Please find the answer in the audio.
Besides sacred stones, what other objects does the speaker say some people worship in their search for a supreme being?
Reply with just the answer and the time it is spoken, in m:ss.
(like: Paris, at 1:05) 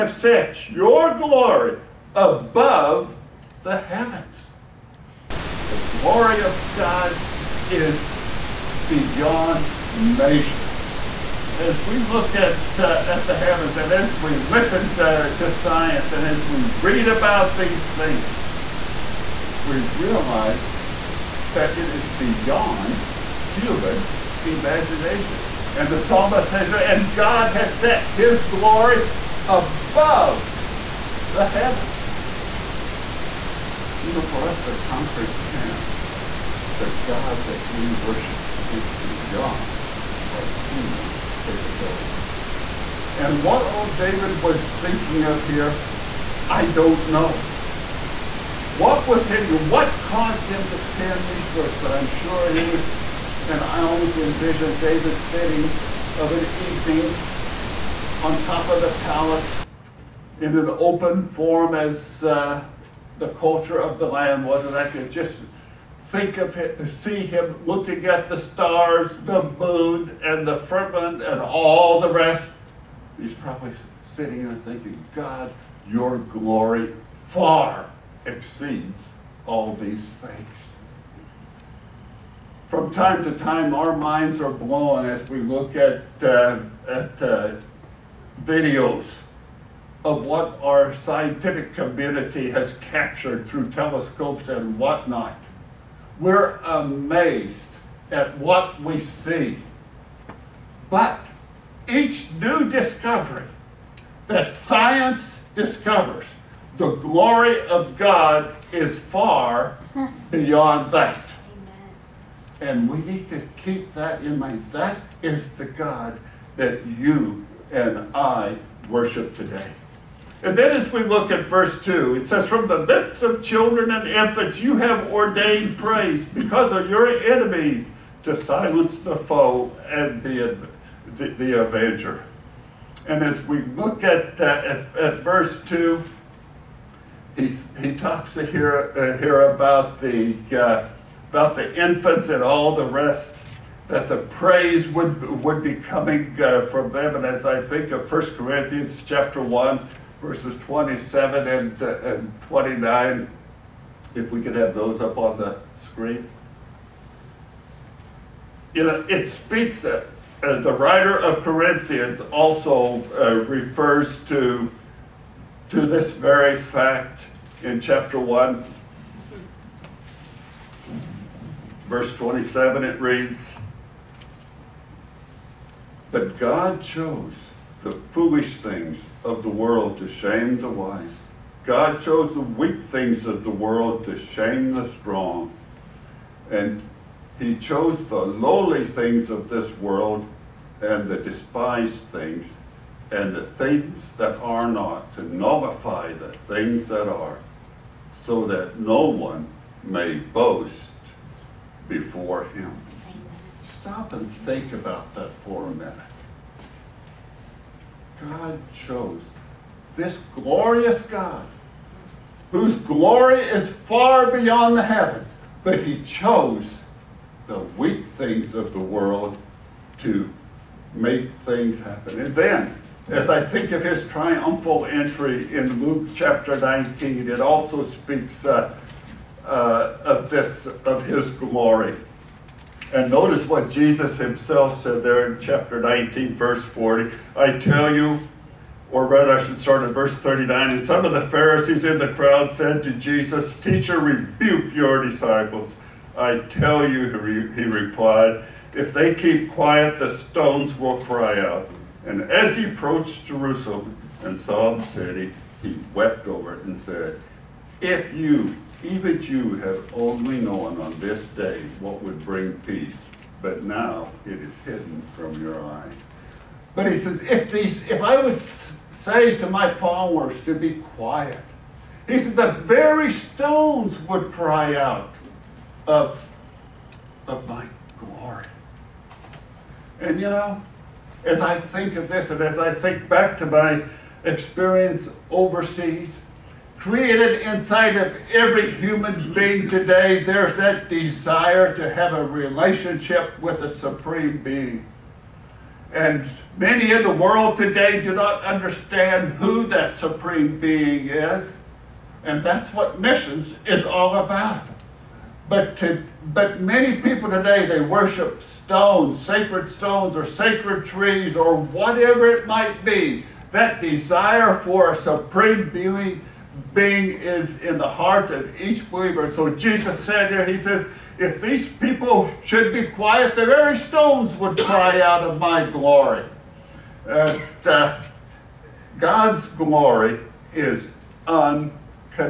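Sacred trees, at 5:10.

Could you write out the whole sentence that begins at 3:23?
Stop and think about that for a minute.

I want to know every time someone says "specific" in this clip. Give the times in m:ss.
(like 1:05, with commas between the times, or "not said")
not said.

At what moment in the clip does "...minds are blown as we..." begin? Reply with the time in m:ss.
1:23.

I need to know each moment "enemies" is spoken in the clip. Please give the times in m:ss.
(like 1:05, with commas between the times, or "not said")
2:07.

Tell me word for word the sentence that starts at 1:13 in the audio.
He's probably sitting there thinking, God, your glory far exceeds all these things.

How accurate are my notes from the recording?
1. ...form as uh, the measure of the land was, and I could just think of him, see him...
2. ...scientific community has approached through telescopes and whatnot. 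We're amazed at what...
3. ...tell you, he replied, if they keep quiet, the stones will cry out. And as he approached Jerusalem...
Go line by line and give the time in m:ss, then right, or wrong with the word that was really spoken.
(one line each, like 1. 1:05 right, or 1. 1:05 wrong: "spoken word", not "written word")
1. 1:01 wrong: "culture", not "measure"
2. 1:31 wrong: "captured", not "approached"
3. 4:06 right.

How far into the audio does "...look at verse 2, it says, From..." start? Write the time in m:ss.
2:01.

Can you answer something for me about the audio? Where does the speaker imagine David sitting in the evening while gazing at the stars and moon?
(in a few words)
On top of the palace.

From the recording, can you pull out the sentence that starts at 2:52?
It reads, But God chose the foolish things of the world to shame the wise.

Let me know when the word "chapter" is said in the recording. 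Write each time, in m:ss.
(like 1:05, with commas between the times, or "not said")
2:29, 2:47, 3:46, 3:55.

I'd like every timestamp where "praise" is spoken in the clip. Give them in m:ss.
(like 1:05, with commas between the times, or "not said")
2:05, 2:24.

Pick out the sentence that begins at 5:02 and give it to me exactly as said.
And that's what missions is all about.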